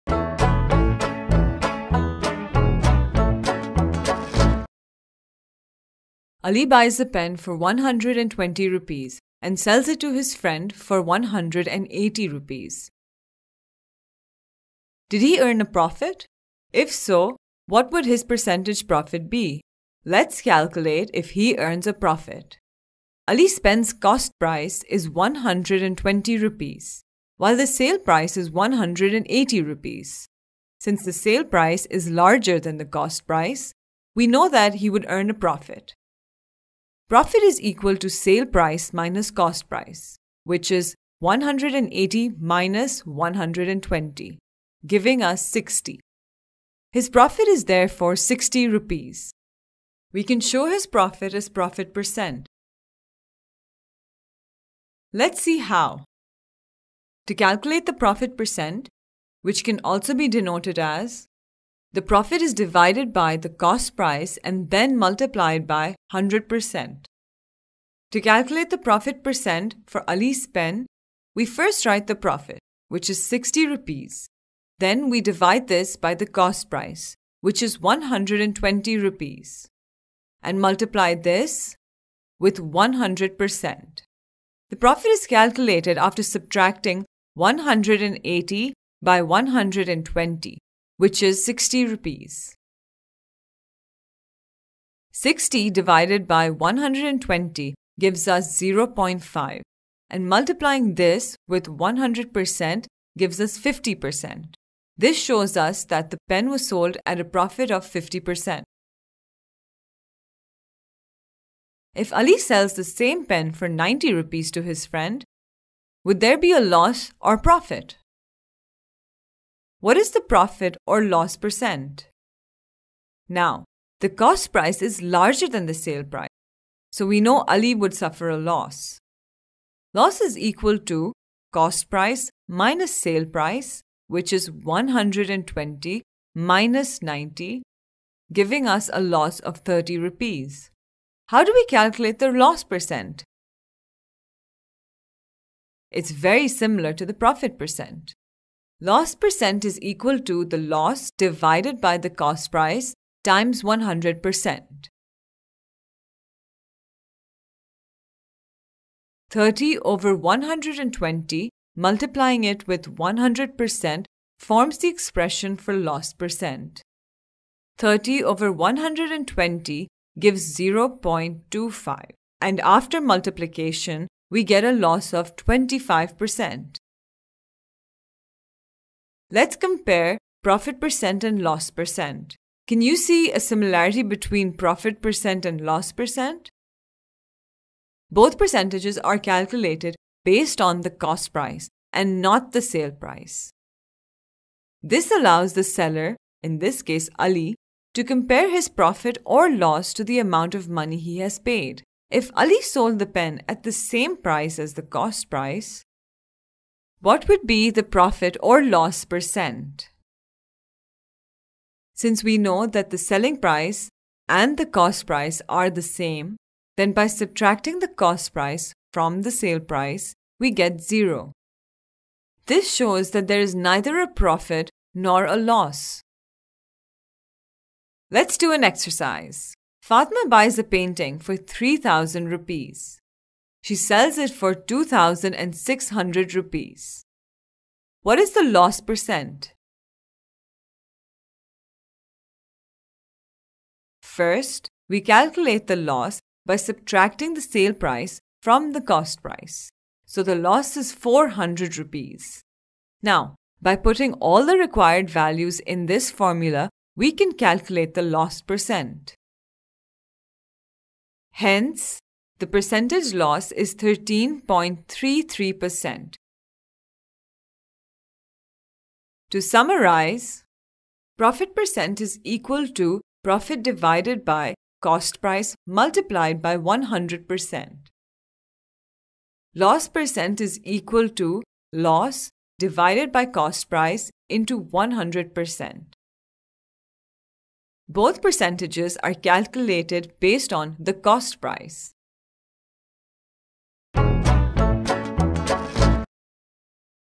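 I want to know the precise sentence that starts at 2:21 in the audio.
How do we calculate the loss percent?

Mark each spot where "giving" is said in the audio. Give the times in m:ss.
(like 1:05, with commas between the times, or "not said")
0:44, 2:18.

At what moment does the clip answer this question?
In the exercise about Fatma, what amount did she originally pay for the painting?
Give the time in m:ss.
3:51.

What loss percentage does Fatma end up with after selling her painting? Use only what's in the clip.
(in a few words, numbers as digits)
13.33%.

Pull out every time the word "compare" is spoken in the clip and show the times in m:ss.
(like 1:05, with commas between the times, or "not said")
2:59, 3:18.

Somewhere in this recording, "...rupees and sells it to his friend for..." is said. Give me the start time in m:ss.
0:08.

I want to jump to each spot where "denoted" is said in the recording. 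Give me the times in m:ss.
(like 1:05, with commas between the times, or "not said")
1:00.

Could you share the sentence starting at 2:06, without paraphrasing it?
So we know Ali would suffer a loss.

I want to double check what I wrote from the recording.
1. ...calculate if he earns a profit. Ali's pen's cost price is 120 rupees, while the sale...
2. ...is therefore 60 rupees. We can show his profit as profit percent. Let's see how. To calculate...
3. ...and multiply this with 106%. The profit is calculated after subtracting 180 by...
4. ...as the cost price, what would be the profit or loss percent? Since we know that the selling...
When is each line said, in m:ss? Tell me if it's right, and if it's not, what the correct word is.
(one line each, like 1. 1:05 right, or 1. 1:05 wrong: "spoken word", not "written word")
1. 0:20 right
2. 0:47 right
3. 1:20 wrong: "100", not "106"
4. 3:24 right.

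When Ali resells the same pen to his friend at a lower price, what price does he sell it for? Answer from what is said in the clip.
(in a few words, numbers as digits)
90 rupees.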